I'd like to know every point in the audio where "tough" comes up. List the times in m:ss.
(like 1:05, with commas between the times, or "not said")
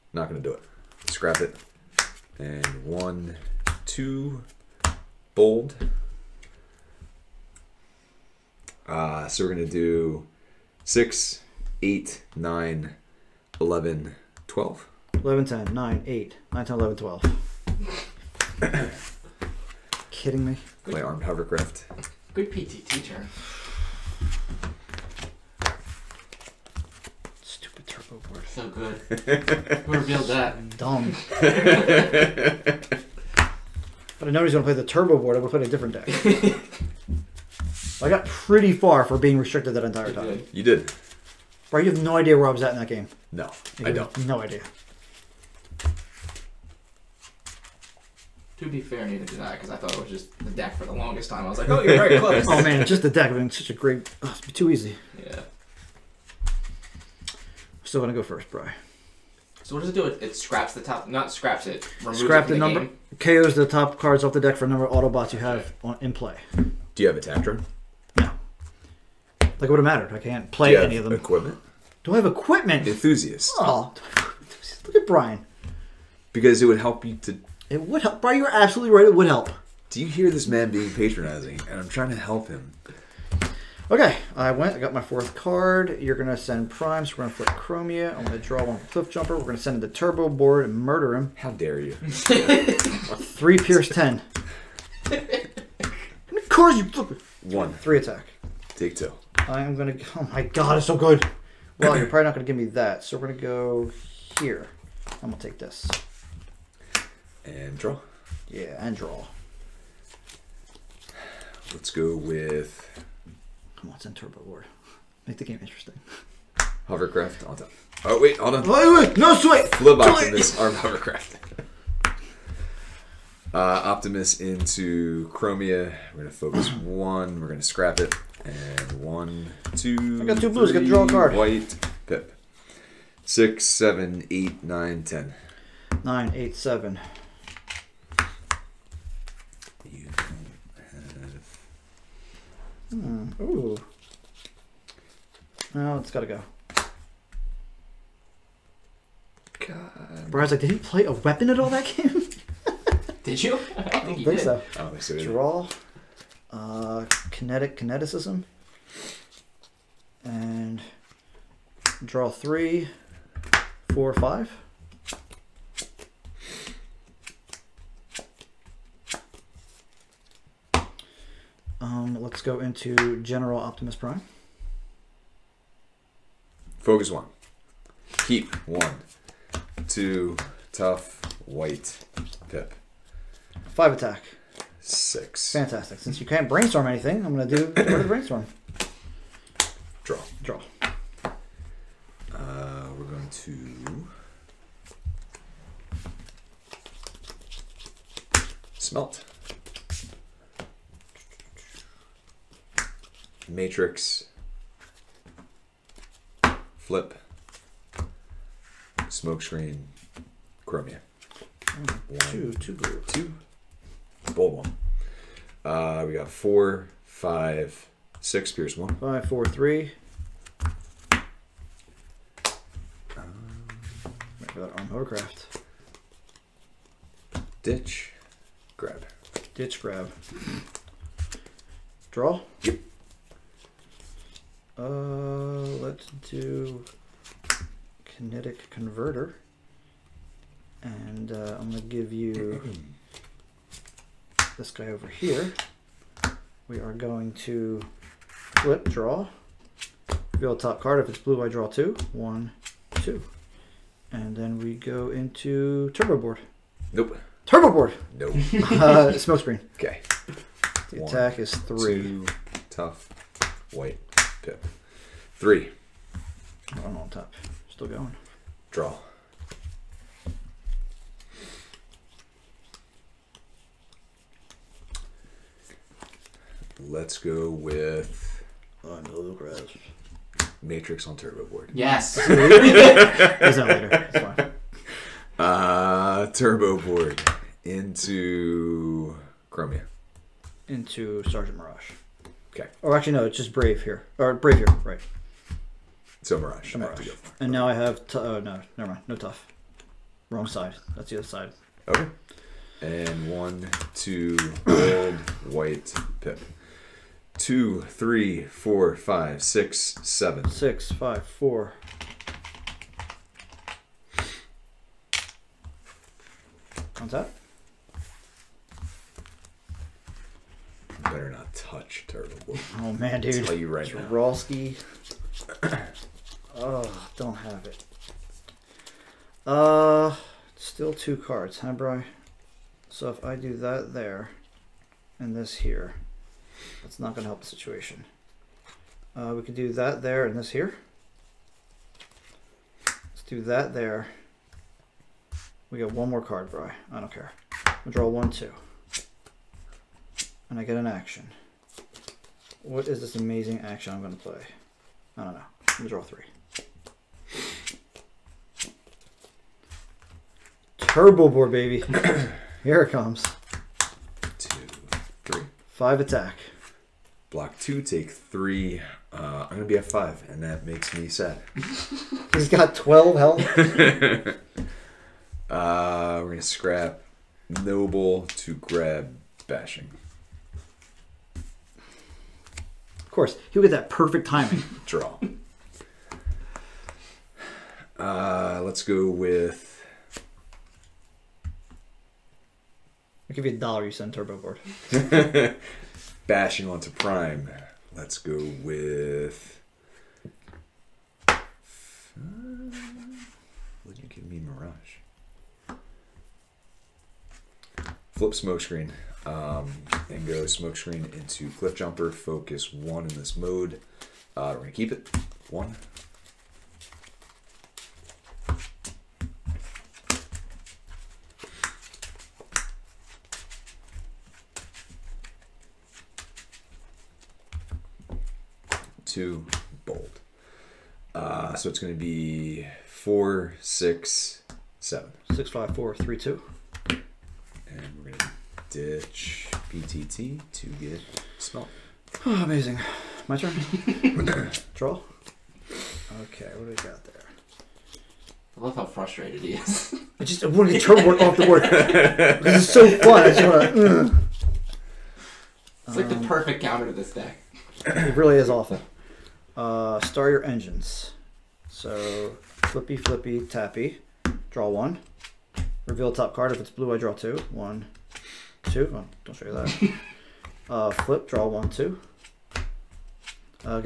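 3:00, 4:22, 4:59.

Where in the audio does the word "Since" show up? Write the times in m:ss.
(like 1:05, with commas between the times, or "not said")
3:05.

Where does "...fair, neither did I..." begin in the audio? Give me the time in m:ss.
0:48.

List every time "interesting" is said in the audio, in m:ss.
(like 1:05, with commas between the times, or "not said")
1:55.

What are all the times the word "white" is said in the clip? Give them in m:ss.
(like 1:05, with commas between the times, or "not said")
2:11, 3:01, 4:23, 5:05.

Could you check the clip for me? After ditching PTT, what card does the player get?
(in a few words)
smelt.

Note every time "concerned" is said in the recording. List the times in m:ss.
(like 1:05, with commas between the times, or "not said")
not said.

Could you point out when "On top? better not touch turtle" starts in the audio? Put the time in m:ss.
5:17.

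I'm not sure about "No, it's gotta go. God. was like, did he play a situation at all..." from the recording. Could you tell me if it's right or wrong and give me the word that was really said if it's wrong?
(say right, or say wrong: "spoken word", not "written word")
wrong: "weapon", not "situation".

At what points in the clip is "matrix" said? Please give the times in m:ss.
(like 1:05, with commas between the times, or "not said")
3:23, 4:40.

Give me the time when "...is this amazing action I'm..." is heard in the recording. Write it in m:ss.
5:52.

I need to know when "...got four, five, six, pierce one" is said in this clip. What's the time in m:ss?
3:36.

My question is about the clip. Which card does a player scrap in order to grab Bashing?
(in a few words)
Noble.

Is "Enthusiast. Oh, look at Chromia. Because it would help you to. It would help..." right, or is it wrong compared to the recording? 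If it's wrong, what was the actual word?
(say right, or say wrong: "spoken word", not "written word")
wrong: "Brian", not "Chromia".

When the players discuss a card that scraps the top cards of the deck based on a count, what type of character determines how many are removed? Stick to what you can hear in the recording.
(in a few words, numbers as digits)
Autobots.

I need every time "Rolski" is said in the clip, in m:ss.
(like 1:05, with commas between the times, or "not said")
5:24.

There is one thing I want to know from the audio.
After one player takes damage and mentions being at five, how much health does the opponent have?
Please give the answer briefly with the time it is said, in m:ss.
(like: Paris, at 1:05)
12, at 6:12.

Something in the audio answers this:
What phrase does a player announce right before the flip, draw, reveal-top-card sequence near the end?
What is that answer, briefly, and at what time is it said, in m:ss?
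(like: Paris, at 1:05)
start your engines, at 7:40.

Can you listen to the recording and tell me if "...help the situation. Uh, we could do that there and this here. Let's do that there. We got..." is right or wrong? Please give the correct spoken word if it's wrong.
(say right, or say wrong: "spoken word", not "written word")
right.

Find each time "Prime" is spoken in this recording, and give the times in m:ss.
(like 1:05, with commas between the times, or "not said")
1:26, 2:53, 6:36.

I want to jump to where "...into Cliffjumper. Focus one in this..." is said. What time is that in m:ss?
6:51.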